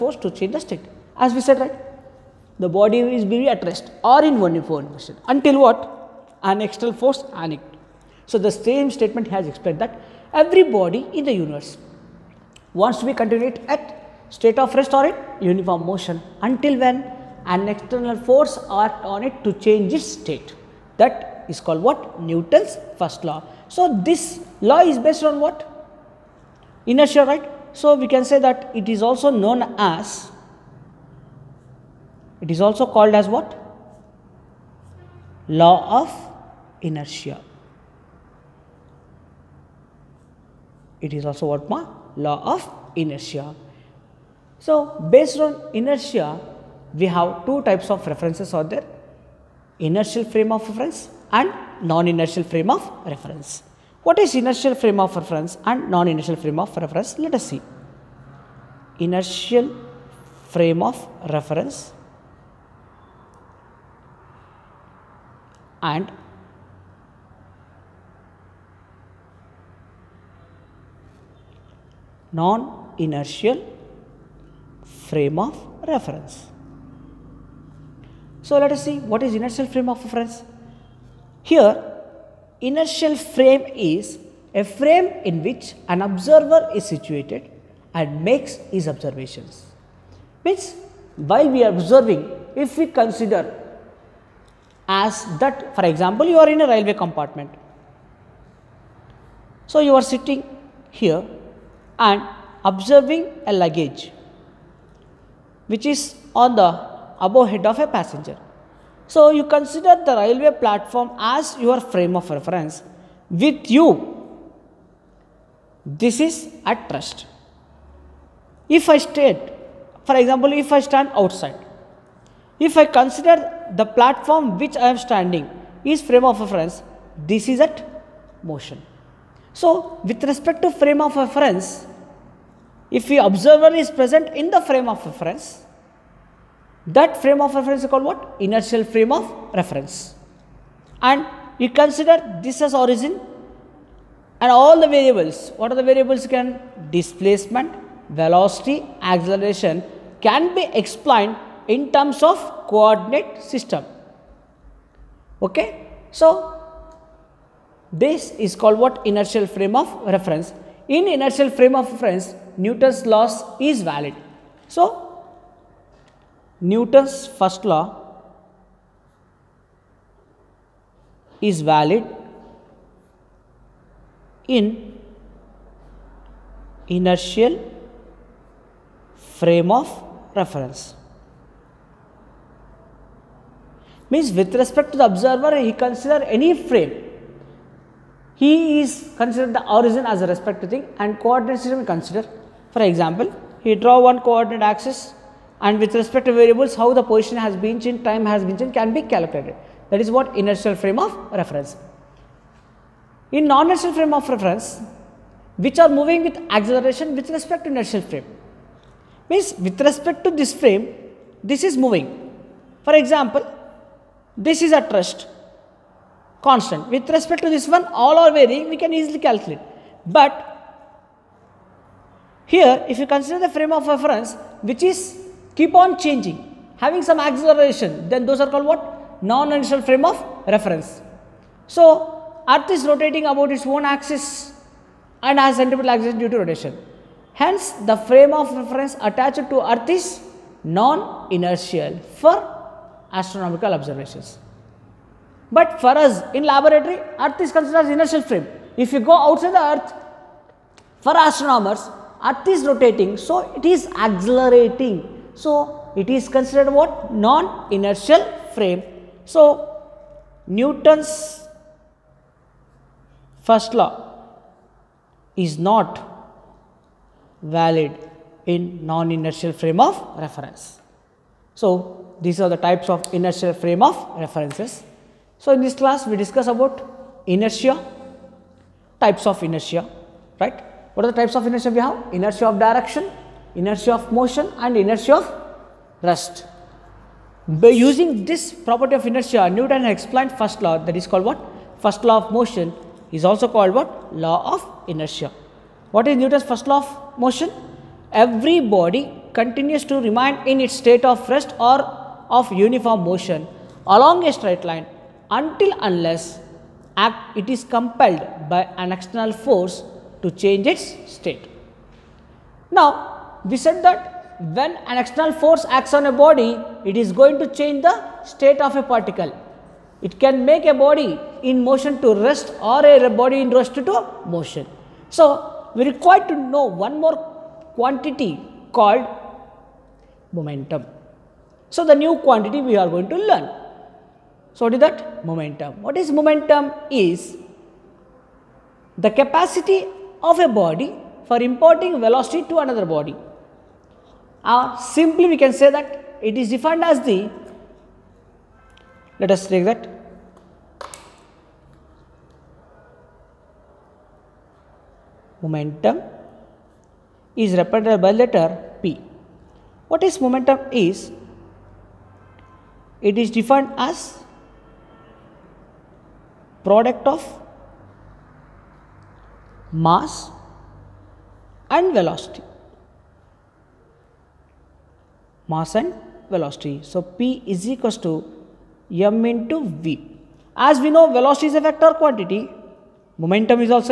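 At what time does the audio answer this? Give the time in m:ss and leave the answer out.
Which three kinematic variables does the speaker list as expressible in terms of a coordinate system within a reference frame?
2:26.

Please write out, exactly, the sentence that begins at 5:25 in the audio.
So, we require to know one more quantity called momentum.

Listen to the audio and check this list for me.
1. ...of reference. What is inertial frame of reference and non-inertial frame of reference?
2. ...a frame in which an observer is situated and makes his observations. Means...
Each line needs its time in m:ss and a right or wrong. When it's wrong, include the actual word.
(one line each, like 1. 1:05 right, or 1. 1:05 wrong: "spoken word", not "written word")
1. 0:52 right
2. 1:24 right.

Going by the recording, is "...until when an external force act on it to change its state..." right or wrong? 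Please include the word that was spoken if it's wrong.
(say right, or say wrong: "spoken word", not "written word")
right.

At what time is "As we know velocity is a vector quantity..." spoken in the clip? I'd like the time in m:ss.
6:20.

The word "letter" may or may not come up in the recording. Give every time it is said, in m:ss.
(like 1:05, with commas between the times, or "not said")
5:58.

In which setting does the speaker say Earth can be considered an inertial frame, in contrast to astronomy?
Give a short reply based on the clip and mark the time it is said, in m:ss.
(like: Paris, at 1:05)
Laboratory, at 4:06.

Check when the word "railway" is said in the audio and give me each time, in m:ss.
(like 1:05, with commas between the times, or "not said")
1:36, 1:50.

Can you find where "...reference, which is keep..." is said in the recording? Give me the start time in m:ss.
3:43.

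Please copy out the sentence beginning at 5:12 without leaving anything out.
Now, we said that when an external force acts on a body, it is going to change the state of a particle.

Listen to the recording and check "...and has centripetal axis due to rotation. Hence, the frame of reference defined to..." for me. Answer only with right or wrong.
wrong.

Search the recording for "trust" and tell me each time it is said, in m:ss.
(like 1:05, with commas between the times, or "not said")
3:34.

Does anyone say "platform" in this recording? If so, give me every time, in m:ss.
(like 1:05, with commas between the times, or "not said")
1:50, 2:03.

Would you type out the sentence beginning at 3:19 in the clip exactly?
That is what inertial frame of reference.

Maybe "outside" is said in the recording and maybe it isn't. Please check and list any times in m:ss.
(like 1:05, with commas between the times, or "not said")
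2:01, 4:09.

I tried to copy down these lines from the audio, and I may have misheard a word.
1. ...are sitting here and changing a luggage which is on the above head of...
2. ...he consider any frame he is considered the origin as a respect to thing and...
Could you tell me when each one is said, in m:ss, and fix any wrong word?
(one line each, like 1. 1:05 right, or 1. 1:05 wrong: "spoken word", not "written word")
1. 1:39 wrong: "observing", not "changing"
2. 3:05 right.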